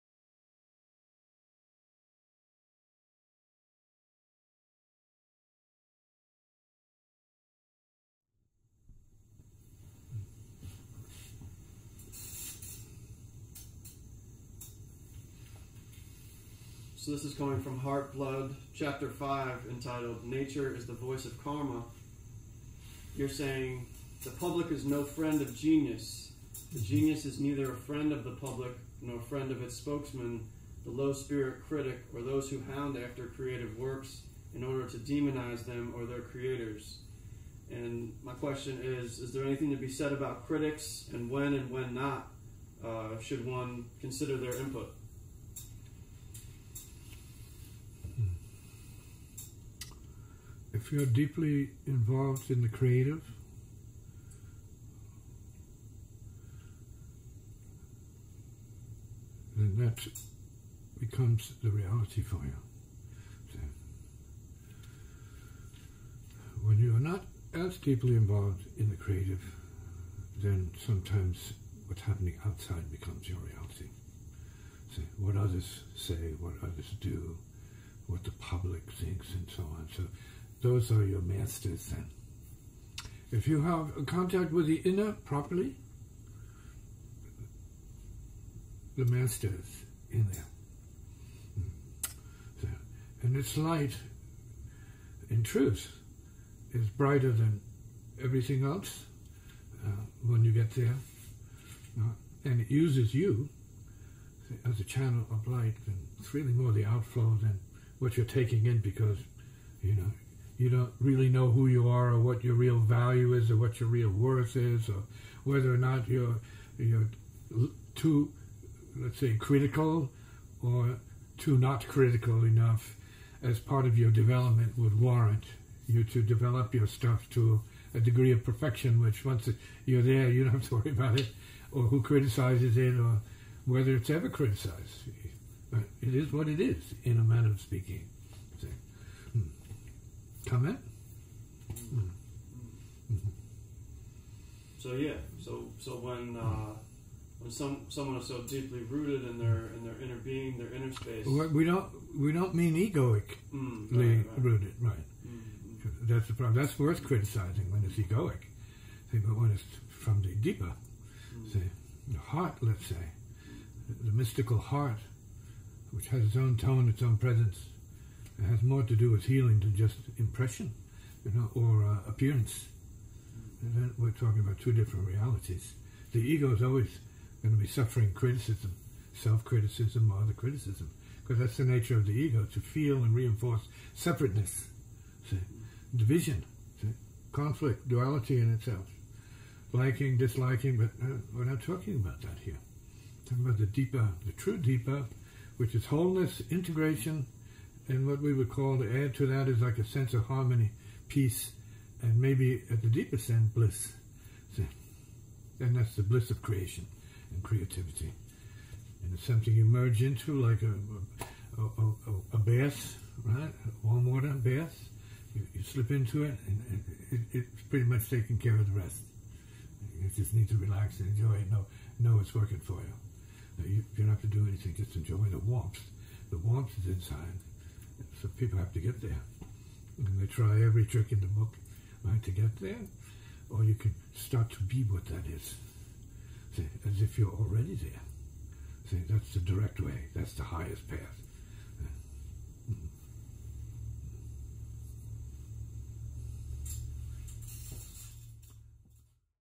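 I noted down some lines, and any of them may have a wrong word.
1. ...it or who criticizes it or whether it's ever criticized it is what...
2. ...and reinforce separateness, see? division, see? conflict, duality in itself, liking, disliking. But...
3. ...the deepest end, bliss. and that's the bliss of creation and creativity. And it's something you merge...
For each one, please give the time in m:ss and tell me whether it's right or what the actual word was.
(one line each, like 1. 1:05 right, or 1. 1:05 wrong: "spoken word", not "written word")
1. 2:11 right
2. 3:03 right
3. 3:22 right.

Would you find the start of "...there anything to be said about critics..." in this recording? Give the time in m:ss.
0:39.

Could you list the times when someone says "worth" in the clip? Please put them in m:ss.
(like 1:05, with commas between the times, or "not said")
1:54, 2:36.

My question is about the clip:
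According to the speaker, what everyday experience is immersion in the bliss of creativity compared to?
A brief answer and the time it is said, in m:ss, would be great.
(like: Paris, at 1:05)
Warm water bath, at 3:33.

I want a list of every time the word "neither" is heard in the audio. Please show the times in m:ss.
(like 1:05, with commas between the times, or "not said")
0:27.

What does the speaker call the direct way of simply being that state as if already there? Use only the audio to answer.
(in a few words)
The highest path.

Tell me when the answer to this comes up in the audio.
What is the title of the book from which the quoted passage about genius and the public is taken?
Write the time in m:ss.
0:17.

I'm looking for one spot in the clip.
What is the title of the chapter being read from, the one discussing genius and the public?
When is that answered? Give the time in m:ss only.
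0:20.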